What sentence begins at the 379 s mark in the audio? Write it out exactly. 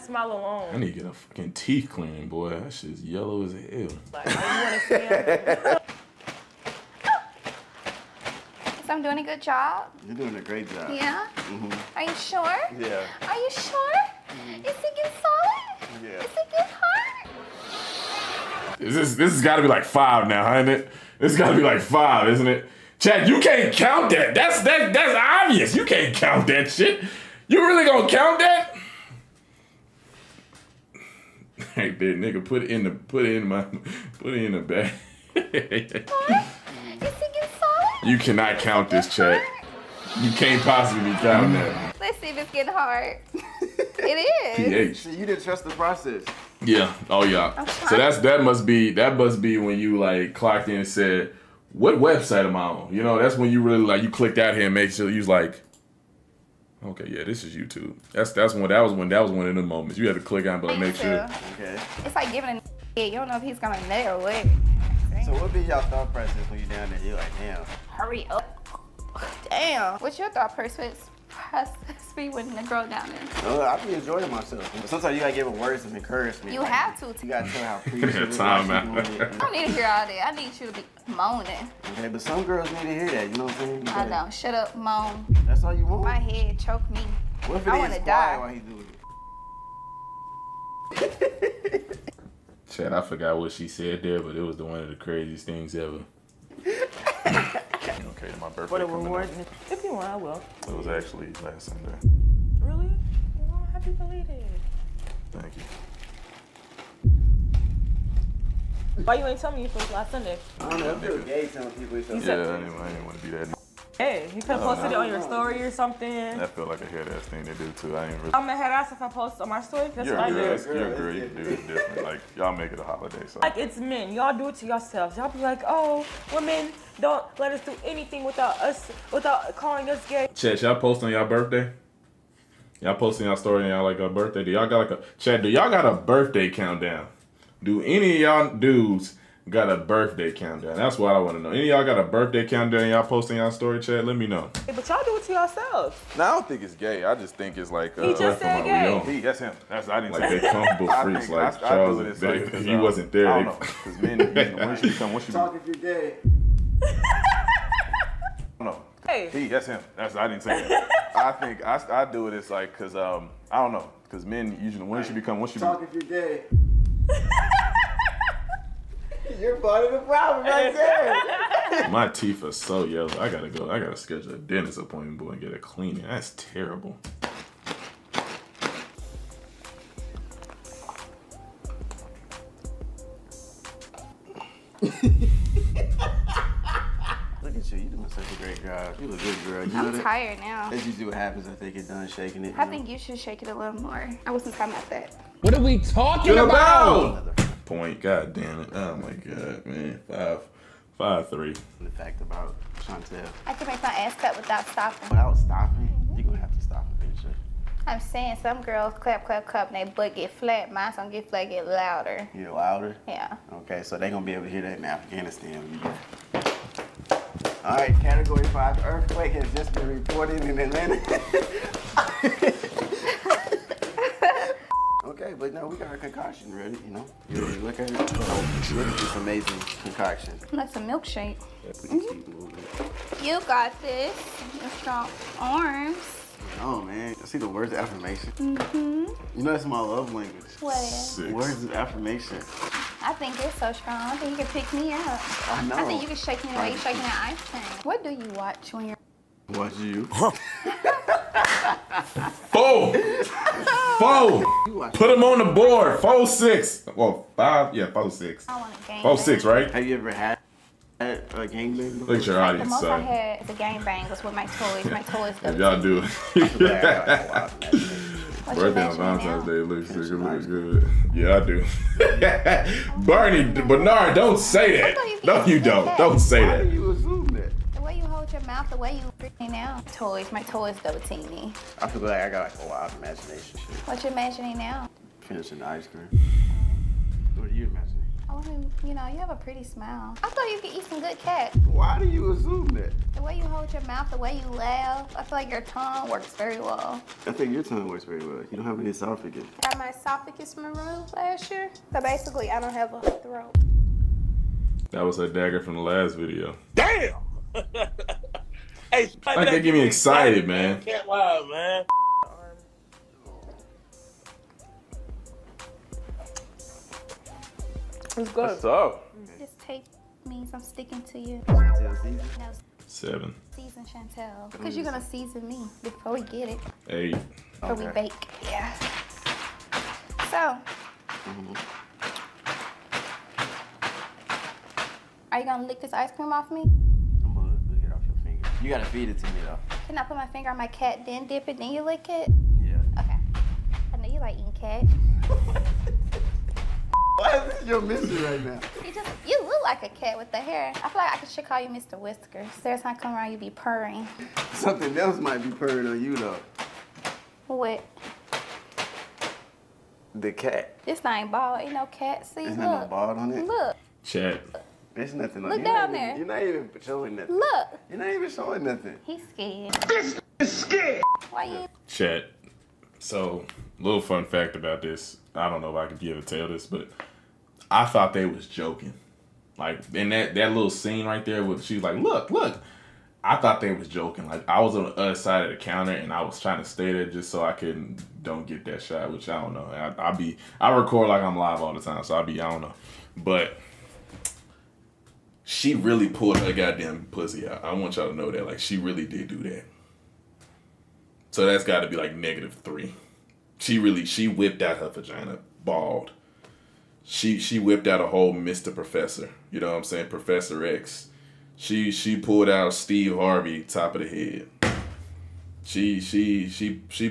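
Like in that that little scene right there, where she's like, "Look, look." I thought they was joking.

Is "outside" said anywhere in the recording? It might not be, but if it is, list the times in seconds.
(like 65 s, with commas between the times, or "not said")
not said.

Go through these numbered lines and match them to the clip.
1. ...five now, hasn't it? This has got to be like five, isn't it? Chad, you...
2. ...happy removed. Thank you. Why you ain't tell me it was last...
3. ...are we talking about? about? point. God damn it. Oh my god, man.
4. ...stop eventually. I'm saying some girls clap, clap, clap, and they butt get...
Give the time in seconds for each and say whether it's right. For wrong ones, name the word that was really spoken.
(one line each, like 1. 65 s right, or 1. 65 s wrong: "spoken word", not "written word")
1. 19 s right
2. 103 s wrong: "belated", not "removed"
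3. 195 s right
4. 206 s right.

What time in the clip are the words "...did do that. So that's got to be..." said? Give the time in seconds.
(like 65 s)
399 s.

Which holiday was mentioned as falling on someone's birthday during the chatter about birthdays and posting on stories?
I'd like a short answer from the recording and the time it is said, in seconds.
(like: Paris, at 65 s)
Valentine's Day, at 268 s.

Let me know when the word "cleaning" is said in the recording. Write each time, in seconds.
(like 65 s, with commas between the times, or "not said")
1 s, 175 s.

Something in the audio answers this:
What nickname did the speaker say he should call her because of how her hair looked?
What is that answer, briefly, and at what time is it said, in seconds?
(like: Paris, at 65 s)
Mr. Whiskers, at 351 s.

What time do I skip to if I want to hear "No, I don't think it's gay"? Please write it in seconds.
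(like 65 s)
146 s.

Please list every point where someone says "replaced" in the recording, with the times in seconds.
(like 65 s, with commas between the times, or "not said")
not said.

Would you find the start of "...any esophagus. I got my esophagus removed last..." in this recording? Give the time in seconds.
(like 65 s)
298 s.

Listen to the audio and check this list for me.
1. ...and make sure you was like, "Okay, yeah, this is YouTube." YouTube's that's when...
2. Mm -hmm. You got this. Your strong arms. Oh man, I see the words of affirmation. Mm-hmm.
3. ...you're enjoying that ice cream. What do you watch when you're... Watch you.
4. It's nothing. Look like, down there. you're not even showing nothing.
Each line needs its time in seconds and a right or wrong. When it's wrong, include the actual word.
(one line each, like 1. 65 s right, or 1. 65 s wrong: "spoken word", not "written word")
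1. 54 s wrong: "That", not "YouTube"
2. 231 s right
3. 246 s wrong: "shaking", not "enjoying"
4. 364 s right.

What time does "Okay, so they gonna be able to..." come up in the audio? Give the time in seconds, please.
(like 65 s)
213 s.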